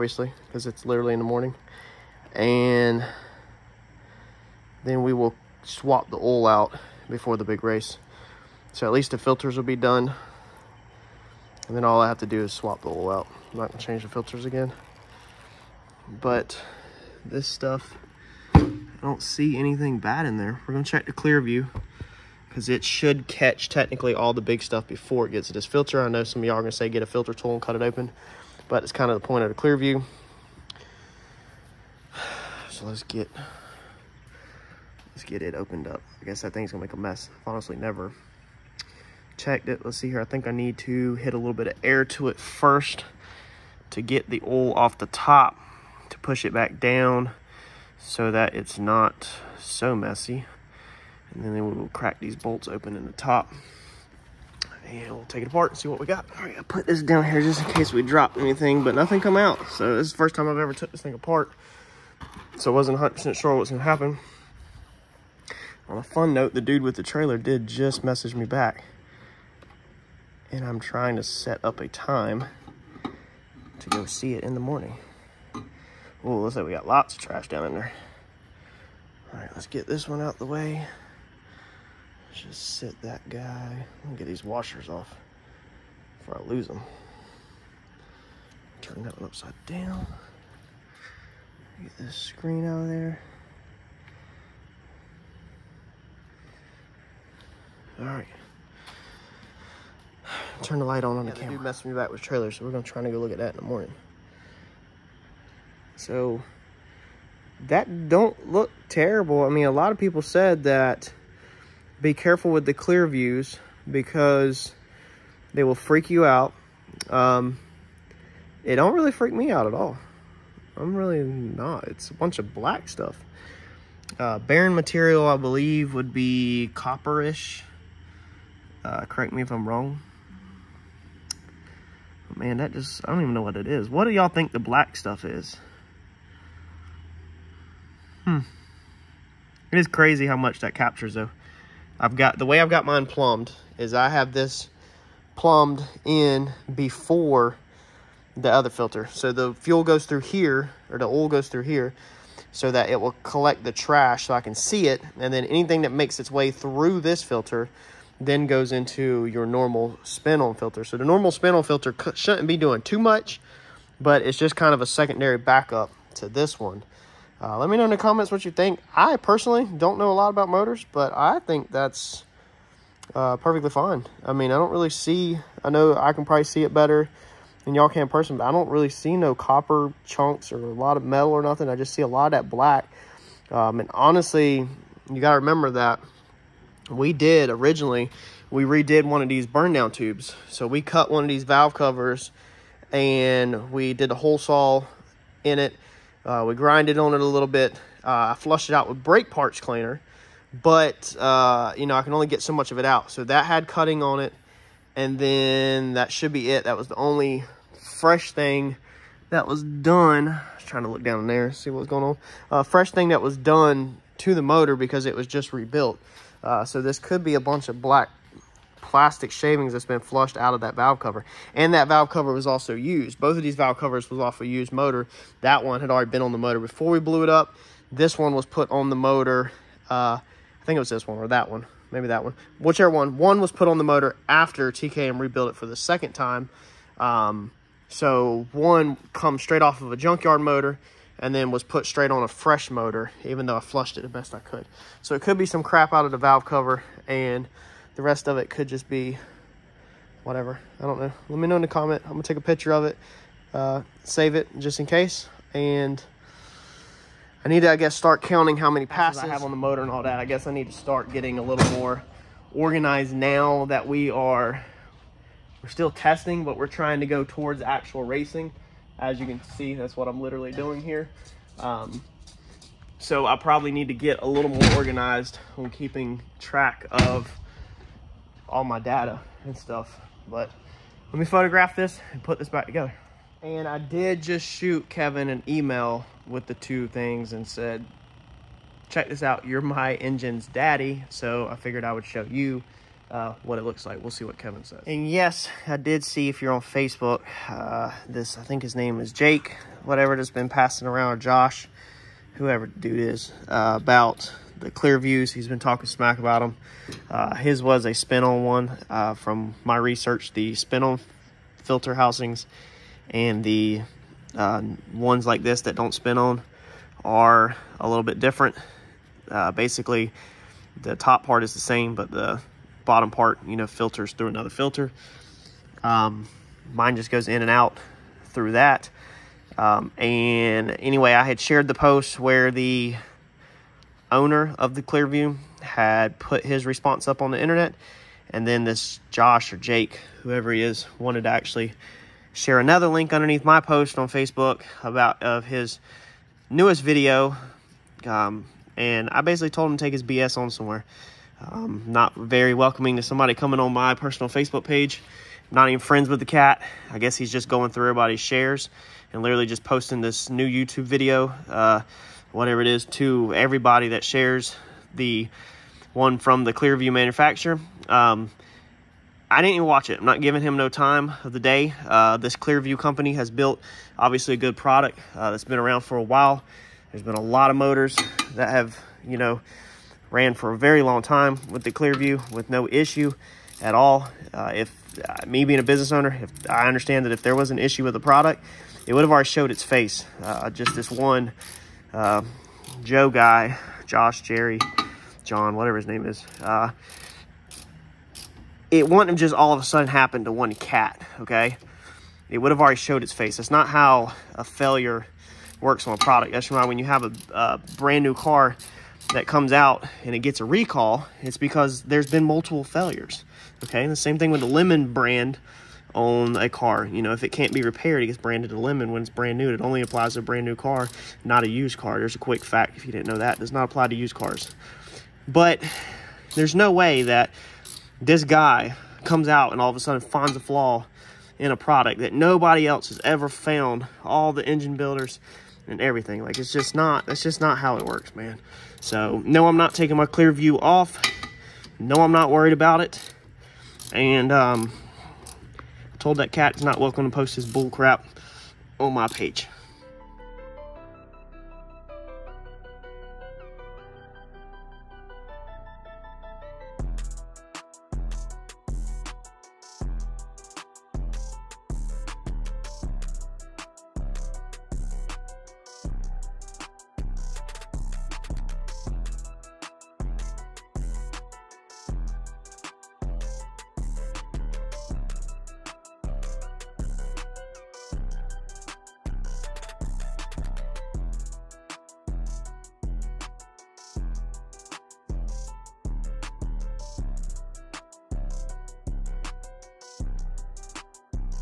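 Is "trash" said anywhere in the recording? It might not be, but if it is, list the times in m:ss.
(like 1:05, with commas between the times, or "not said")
1:17, 2:33.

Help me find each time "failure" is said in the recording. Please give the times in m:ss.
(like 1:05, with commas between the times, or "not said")
6:44, 6:52.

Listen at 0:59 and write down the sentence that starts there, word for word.
So this is the first time I've ever took this thing apart.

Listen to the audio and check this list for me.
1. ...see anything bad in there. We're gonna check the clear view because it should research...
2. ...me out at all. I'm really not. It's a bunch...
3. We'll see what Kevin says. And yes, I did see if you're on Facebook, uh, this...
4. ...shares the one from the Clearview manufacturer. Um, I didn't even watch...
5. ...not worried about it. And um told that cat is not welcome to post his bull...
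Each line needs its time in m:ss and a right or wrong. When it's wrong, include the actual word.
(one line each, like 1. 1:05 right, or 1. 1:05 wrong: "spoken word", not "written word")
1. 0:19 wrong: "catch", not "research"
2. 1:59 right
3. 4:54 right
4. 6:04 right
5. 7:22 right.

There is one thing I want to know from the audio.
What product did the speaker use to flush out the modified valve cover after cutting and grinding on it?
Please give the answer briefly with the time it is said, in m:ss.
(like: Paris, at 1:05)
brake parts cleaner, at 3:19.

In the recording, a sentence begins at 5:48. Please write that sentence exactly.
Um, and I basically told him to take his BS on somewhere.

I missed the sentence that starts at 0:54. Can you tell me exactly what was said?
And we'll take it apart and see what we got.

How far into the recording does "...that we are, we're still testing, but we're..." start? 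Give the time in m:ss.
4:23.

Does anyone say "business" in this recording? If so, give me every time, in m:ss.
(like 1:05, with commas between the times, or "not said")
6:25.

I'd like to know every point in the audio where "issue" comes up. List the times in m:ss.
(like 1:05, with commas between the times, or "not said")
6:22, 6:27.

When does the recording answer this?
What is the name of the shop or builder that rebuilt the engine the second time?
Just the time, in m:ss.
3:54.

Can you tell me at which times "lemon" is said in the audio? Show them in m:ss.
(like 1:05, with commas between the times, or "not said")
6:54, 6:58.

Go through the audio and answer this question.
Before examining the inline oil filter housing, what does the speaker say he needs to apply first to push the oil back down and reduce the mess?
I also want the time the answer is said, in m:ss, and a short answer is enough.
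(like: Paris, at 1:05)
air, at 0:41.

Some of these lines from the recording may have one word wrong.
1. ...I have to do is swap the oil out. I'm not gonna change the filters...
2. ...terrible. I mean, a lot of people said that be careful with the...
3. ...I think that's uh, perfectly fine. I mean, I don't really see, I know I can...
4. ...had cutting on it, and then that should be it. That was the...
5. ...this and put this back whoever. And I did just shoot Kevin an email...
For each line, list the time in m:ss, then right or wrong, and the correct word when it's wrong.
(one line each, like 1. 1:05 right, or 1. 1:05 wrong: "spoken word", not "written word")
1. 0:12 right
2. 1:48 right
3. 2:51 right
4. 3:23 right
5. 4:41 wrong: "together", not "whoever".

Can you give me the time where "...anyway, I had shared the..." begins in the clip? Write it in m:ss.
5:30.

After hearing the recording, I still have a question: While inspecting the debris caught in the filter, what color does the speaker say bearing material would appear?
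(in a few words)
copperish.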